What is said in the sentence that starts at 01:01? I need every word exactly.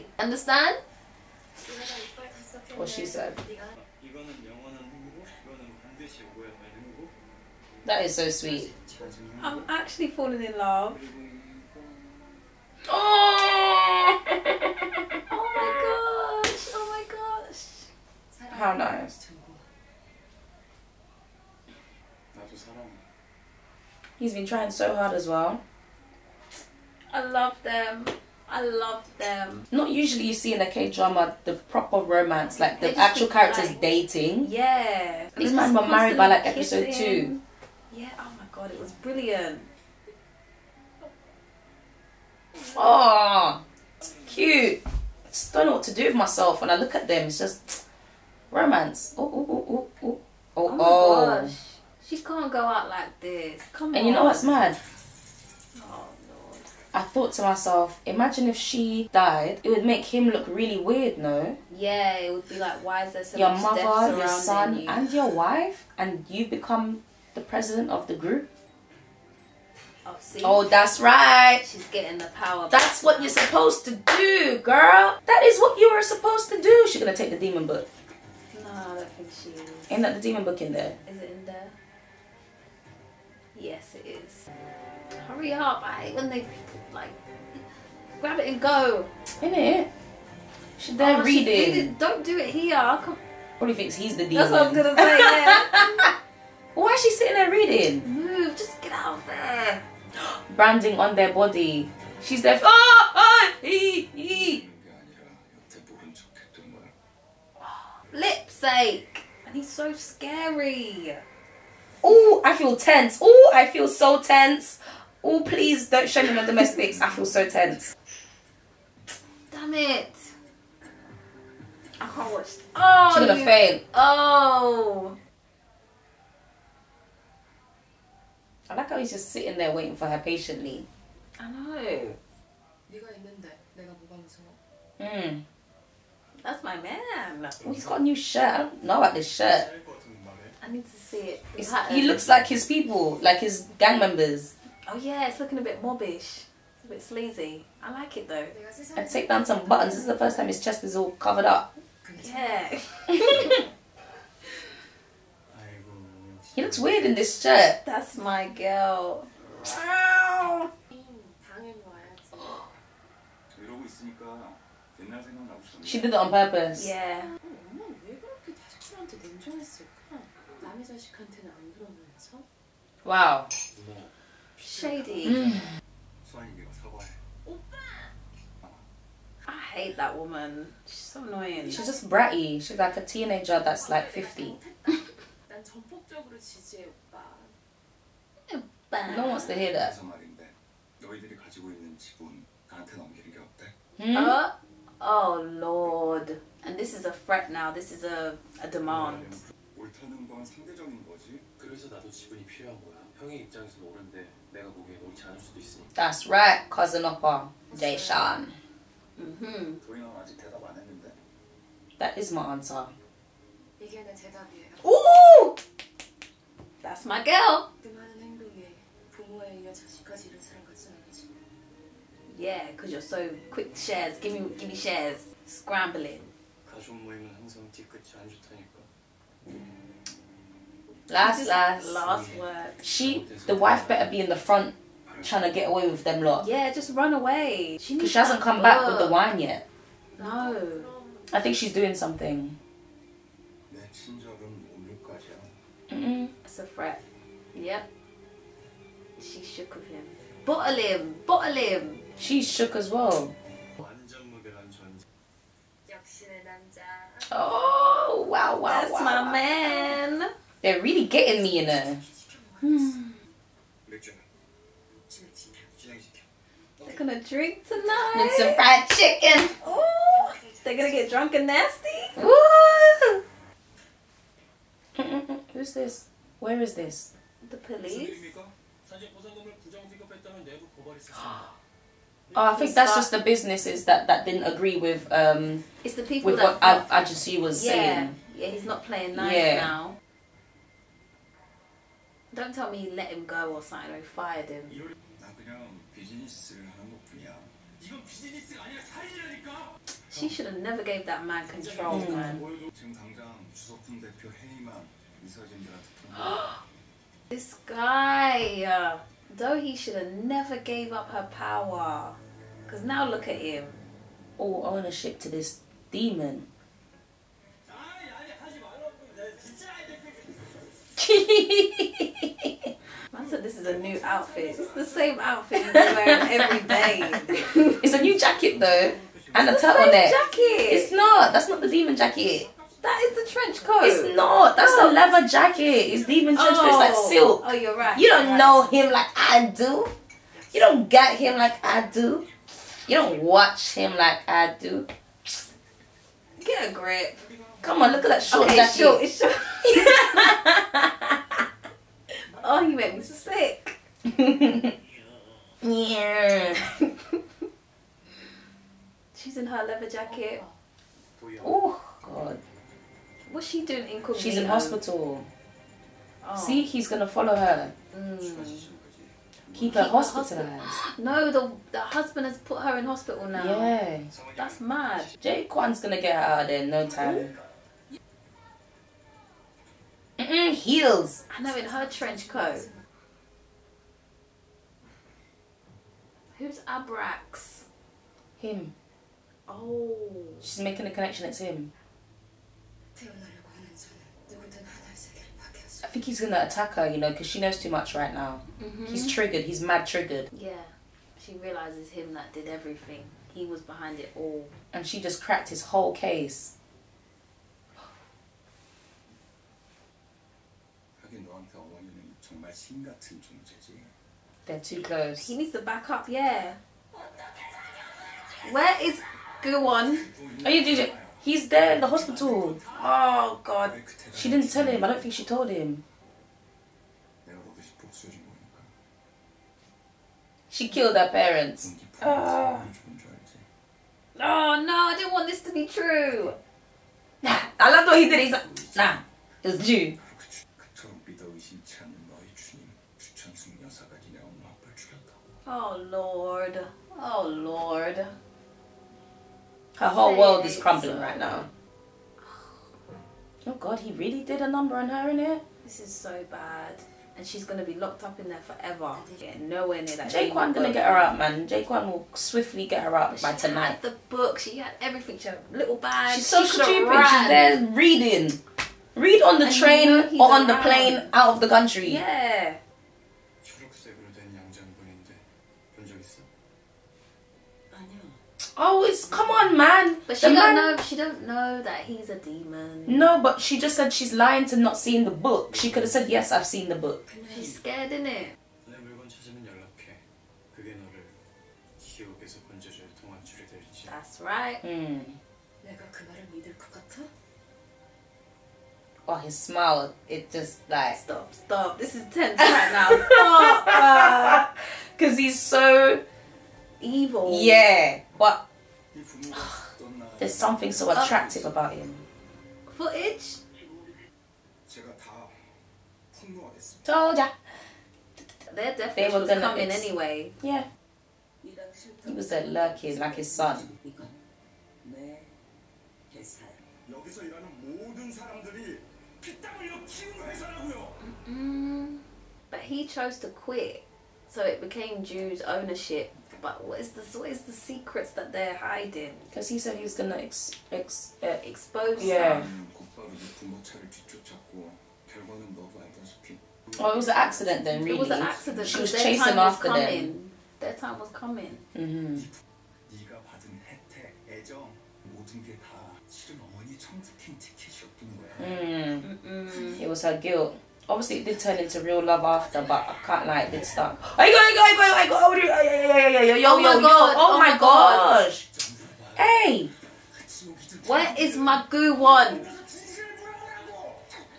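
Yeah, it would be like, why is there so your much mother, death your son, you?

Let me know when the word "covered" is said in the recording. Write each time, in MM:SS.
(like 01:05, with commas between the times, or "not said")
02:31.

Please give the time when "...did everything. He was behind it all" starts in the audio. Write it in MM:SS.
06:42.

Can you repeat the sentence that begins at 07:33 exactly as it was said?
Oh God, he really did a number on her in it.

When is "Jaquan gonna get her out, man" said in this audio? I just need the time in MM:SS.
07:40.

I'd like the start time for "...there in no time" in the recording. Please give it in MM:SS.
06:16.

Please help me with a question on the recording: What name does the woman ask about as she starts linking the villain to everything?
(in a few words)
Abrax.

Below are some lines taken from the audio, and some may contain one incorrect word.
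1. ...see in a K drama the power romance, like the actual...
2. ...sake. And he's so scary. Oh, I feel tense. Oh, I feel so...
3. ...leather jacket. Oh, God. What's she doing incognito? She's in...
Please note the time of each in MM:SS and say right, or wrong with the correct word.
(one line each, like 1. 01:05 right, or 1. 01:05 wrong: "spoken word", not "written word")
1. 00:30 wrong: "proper", not "power"
2. 01:48 right
3. 05:59 right.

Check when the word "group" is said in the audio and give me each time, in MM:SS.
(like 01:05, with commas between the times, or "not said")
01:08.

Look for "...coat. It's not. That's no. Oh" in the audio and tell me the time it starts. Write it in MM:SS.
05:33.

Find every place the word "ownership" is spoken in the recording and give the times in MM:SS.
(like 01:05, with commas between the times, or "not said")
05:14, 08:55.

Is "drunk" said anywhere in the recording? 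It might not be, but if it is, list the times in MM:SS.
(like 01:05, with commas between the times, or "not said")
04:31.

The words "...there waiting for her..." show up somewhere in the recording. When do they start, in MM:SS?
02:09.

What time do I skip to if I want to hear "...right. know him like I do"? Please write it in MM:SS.
05:38.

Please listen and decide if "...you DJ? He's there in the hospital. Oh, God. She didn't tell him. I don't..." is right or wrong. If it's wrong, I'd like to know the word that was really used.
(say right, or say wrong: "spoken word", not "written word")
right.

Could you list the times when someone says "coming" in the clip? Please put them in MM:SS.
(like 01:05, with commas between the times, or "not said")
08:39, 09:11.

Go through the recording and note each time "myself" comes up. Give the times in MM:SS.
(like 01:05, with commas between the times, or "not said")
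00:46, 00:57.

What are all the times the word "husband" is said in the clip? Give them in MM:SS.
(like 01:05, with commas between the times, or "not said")
06:11.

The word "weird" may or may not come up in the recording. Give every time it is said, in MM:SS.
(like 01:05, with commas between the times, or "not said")
01:00, 02:36.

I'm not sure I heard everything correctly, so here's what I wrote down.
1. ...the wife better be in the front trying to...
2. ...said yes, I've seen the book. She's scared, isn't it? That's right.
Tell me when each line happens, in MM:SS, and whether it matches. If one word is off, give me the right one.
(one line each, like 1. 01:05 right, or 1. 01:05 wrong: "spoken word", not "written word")
1. 03:53 right
2. 08:05 right.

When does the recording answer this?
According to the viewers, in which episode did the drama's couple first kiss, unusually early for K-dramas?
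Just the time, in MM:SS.
00:36.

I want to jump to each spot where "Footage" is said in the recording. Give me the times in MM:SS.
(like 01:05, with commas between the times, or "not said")
08:32.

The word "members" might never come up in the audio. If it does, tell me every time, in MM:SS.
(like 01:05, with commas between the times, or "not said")
02:23.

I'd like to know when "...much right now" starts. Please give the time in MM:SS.
06:37.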